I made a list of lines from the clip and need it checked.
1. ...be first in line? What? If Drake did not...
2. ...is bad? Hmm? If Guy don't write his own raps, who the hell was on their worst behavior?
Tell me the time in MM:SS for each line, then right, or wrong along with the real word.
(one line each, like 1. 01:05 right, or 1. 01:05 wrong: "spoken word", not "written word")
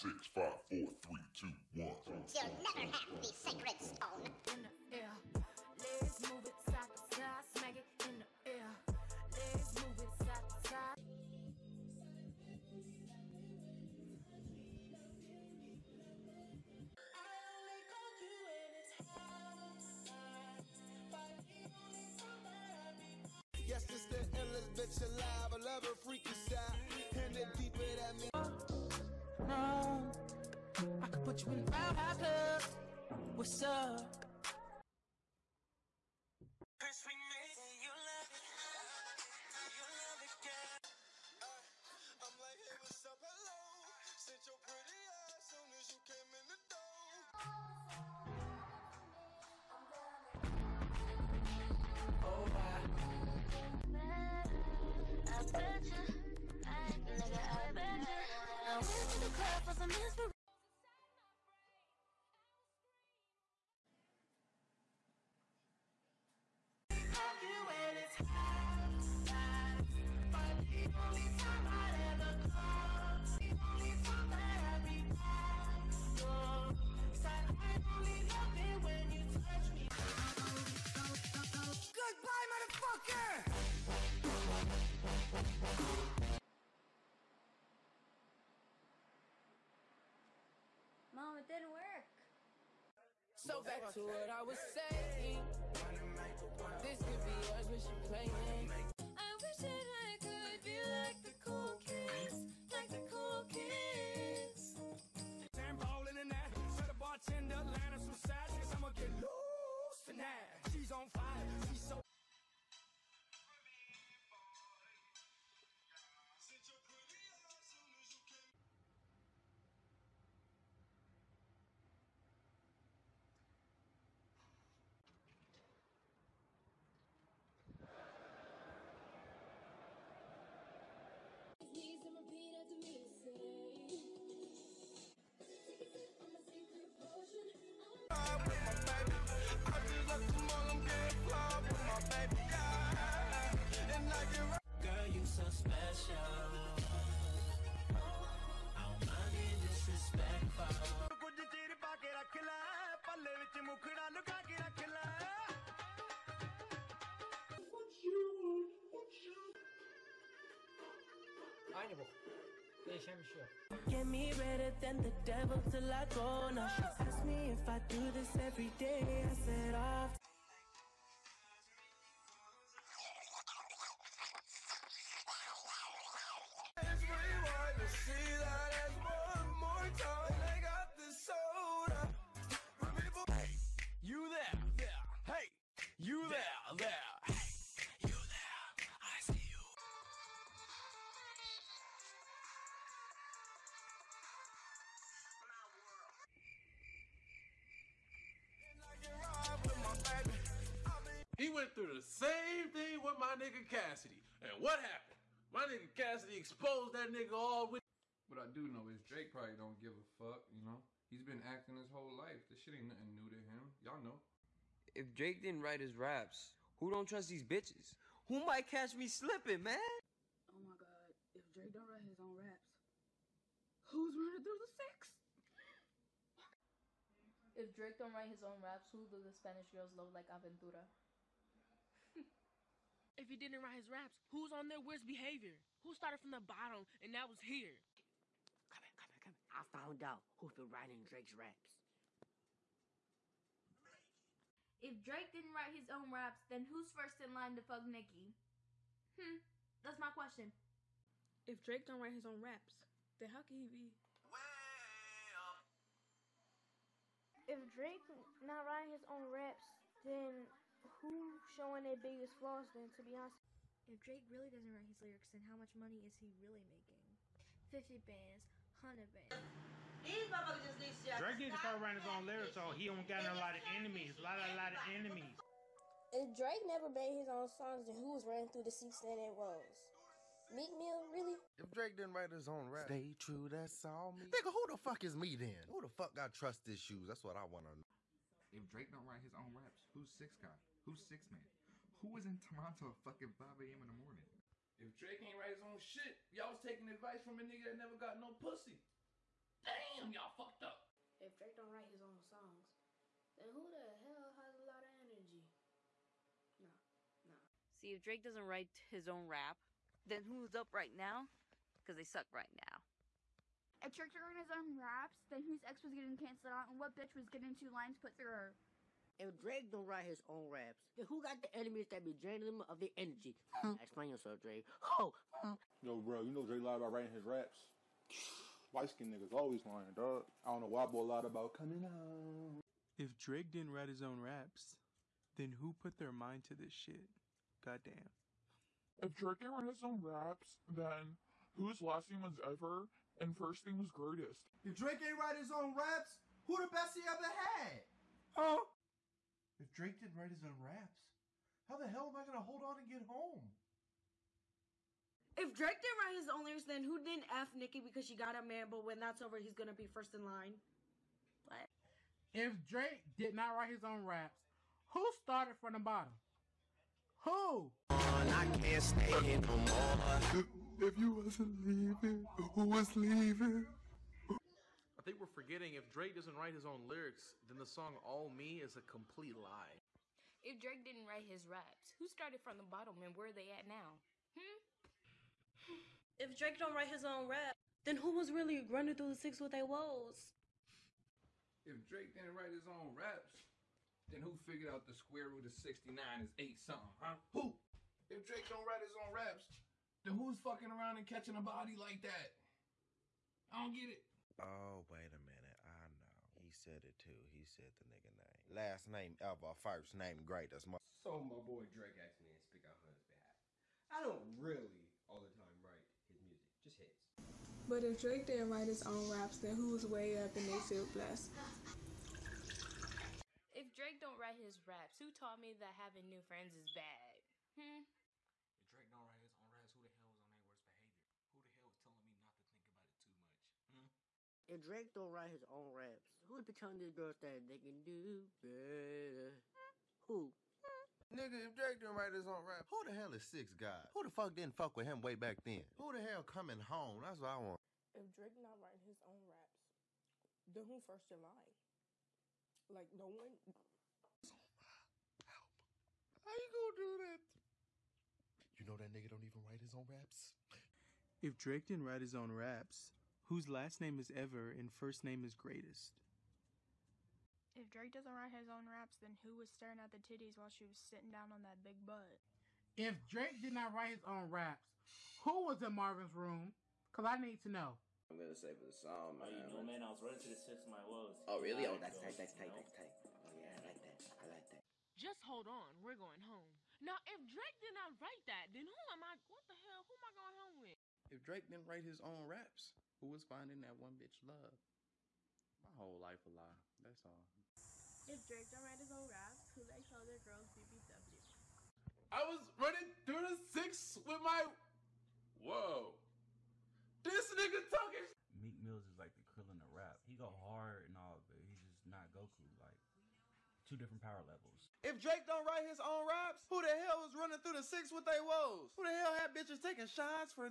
1. 05:59 right
2. 07:06 wrong: "Drake", not "Guy".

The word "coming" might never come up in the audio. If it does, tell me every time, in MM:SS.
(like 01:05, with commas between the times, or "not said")
05:31, 07:26.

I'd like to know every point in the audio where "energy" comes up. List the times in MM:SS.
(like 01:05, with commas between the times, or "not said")
05:05, 05:22.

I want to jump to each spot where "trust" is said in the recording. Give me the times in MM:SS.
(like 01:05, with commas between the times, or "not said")
03:37, 04:46.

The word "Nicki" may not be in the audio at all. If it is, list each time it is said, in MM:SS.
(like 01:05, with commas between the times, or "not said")
04:07, 05:57.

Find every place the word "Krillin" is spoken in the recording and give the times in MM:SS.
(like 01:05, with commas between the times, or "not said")
08:29.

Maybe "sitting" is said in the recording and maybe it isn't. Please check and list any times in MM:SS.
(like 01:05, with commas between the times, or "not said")
07:50.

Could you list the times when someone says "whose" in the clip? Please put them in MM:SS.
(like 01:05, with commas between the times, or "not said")
05:15, 05:41, 07:43.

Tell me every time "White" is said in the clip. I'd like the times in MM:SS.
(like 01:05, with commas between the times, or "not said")
05:28.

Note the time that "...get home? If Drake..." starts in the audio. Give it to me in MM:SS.
05:52.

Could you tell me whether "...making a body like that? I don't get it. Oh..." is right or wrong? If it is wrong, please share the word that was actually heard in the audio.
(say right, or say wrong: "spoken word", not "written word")
wrong: "catching", not "making".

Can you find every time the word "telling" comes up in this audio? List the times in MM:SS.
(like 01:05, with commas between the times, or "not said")
07:11, 07:16.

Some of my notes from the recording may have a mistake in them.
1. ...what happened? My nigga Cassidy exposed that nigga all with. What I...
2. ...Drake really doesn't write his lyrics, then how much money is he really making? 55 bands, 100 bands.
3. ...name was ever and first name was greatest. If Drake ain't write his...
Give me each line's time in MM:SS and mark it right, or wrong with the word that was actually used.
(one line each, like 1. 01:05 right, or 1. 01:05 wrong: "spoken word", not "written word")
1. 03:24 right
2. 04:23 wrong: "50", not "55"
3. 05:42 right.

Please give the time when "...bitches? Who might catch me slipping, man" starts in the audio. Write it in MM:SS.
03:37.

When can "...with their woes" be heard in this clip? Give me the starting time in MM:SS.
06:29.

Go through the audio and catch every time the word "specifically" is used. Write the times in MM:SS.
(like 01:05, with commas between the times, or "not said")
not said.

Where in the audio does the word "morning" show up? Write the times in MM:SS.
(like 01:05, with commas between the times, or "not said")
04:53.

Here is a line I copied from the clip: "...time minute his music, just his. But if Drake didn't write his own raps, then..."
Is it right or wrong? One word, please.
wrong.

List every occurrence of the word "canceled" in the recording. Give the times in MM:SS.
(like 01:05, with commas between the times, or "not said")
05:16.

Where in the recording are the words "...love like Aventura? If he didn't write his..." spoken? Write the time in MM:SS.
03:49.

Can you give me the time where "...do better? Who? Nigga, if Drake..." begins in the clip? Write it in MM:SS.
07:17.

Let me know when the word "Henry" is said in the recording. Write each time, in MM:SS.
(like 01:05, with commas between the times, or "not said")
not said.